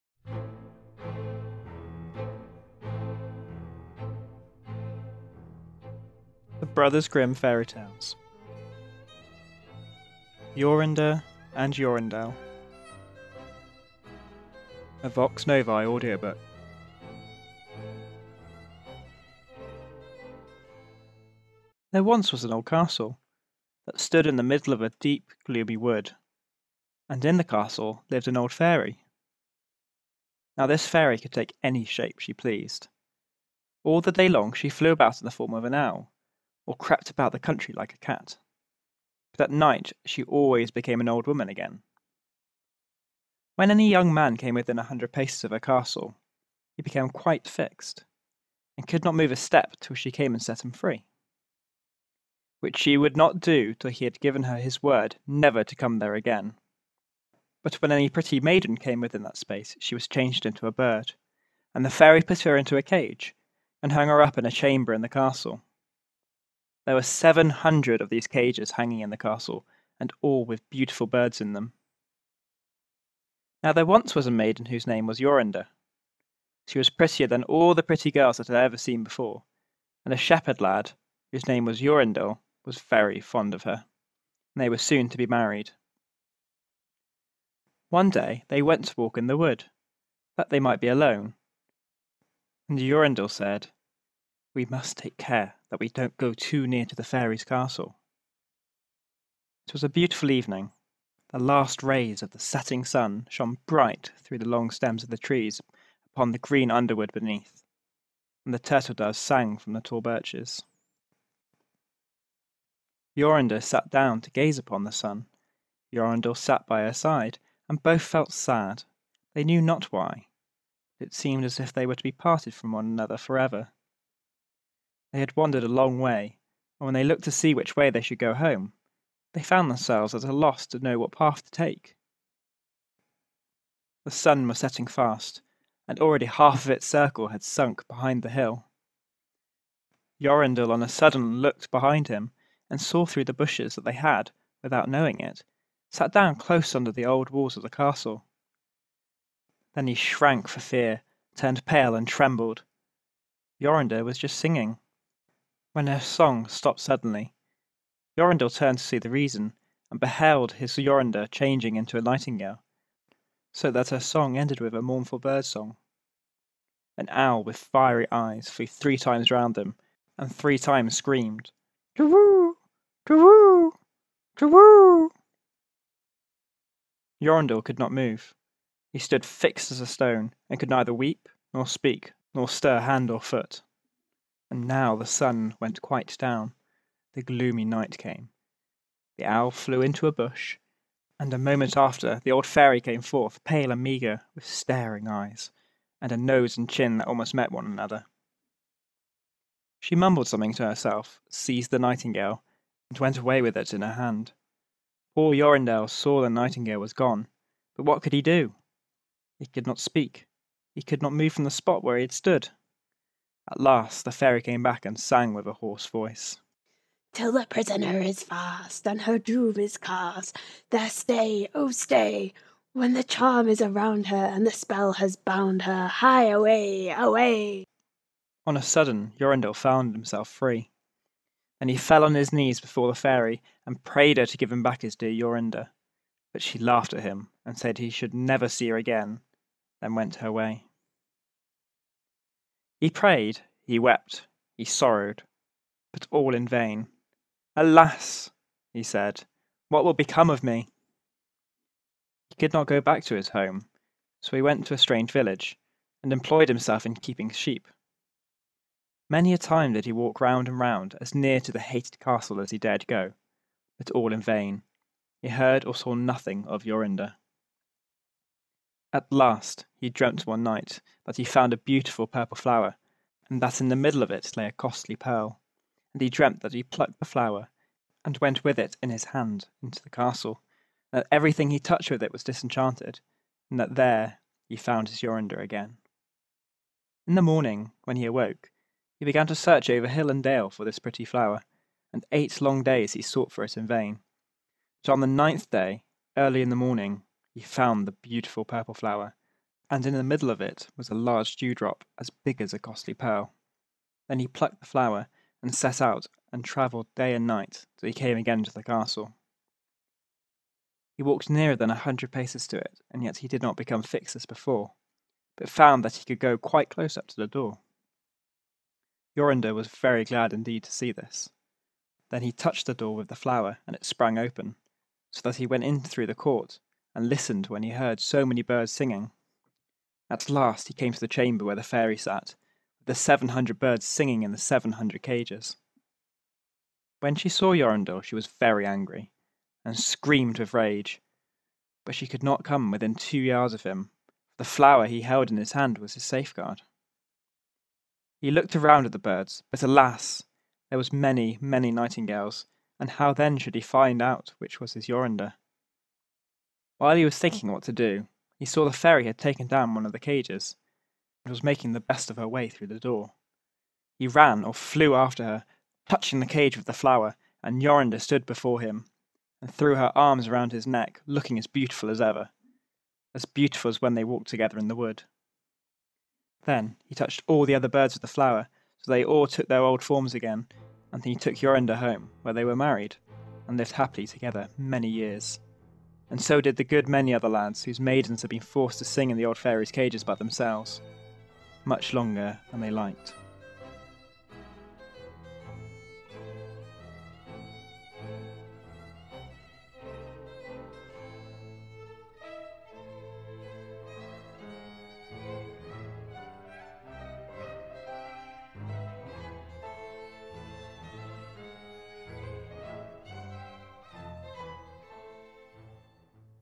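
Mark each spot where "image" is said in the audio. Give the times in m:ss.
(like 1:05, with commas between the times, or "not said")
not said.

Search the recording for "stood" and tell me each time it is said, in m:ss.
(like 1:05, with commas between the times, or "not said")
0:23, 2:58, 3:32, 6:07.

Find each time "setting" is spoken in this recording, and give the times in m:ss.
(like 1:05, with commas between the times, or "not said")
1:42, 2:14.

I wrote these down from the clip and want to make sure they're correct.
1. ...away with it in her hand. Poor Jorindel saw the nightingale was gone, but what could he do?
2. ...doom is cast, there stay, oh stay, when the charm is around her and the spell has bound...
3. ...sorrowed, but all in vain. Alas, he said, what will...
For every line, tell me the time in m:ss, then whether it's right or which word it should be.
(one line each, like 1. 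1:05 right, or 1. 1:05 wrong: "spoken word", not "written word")
1. 3:23 right
2. 3:39 right
3. 4:04 right.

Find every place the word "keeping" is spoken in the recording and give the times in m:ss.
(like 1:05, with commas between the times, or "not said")
4:16.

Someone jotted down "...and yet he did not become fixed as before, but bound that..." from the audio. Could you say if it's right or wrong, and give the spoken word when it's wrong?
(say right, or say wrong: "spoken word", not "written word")
wrong: "found", not "bound".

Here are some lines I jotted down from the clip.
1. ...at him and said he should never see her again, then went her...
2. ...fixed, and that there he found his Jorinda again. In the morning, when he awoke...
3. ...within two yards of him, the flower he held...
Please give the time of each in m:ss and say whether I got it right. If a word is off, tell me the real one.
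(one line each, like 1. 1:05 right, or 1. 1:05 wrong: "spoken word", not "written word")
1. 3:56 right
2. 4:42 wrong: "disenchanted", not "fixed"
3. 5:42 right.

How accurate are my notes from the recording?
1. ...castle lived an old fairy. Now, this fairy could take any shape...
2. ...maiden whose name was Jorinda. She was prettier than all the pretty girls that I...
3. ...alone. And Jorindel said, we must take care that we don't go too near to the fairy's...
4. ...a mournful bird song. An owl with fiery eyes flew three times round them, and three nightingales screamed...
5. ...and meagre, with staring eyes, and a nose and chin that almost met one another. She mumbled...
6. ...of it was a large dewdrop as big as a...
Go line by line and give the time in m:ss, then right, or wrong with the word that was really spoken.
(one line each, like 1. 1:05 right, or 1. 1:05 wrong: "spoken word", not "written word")
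1. 0:27 right
2. 1:14 right
3. 1:30 right
4. 2:44 wrong: "times", not "nightingales"
5. 3:13 right
6. 5:00 right.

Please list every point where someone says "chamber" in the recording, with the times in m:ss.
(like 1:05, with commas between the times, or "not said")
1:04, 5:31.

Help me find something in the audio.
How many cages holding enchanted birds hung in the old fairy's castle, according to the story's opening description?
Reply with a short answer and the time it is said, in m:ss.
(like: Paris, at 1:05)
700, at 1:07.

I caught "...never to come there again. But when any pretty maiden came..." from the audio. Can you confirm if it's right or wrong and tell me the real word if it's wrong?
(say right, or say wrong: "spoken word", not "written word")
right.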